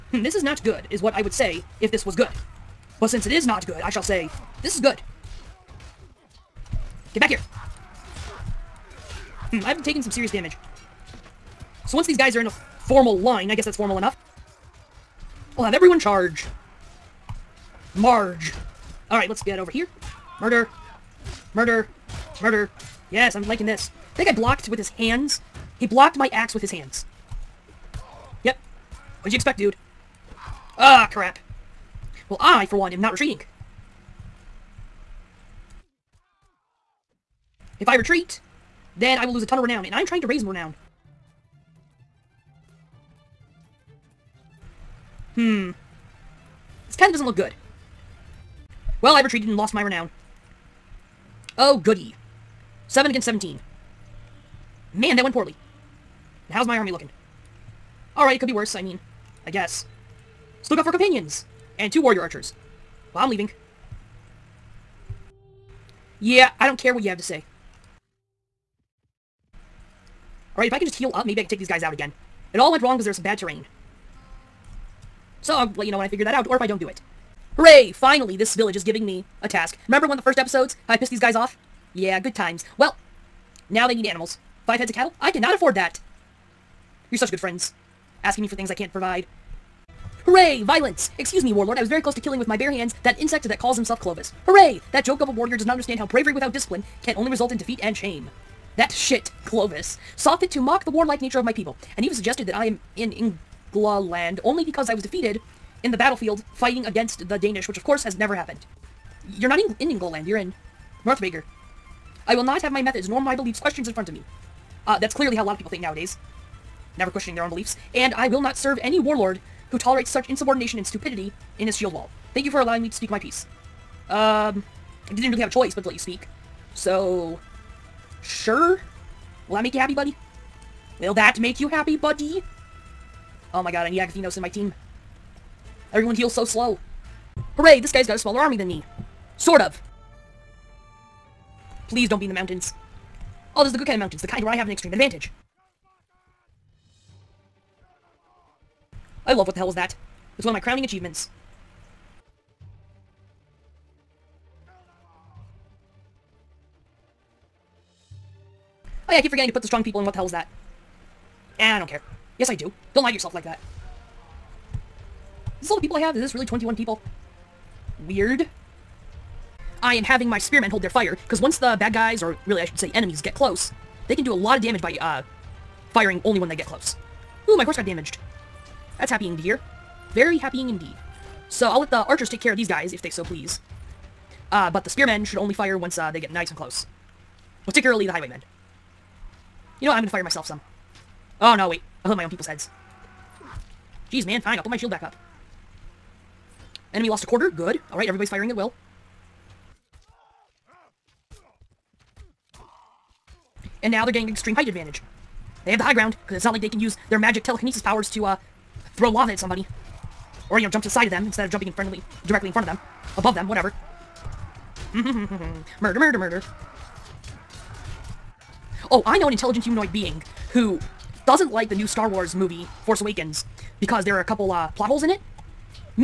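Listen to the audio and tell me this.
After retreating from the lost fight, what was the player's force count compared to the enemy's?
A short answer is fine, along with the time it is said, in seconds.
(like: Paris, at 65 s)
7 against 17, at 52 s.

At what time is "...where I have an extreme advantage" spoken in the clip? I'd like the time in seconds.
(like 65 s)
144 s.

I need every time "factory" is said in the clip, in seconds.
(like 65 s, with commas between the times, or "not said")
not said.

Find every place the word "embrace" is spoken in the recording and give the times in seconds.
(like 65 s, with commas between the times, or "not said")
not said.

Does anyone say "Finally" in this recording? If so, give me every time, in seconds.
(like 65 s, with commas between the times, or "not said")
77 s.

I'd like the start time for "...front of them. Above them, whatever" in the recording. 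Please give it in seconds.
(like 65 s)
212 s.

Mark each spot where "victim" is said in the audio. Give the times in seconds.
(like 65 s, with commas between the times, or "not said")
not said.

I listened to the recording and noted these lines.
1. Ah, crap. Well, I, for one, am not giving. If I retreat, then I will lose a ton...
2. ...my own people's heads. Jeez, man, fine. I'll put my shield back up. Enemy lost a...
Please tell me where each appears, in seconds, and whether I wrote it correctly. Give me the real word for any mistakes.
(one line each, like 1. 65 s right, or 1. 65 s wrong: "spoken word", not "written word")
1. 30 s wrong: "retreating", not "giving"
2. 192 s right.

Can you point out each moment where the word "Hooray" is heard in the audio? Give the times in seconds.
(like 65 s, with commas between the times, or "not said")
77 s, 90 s, 94 s, 137 s.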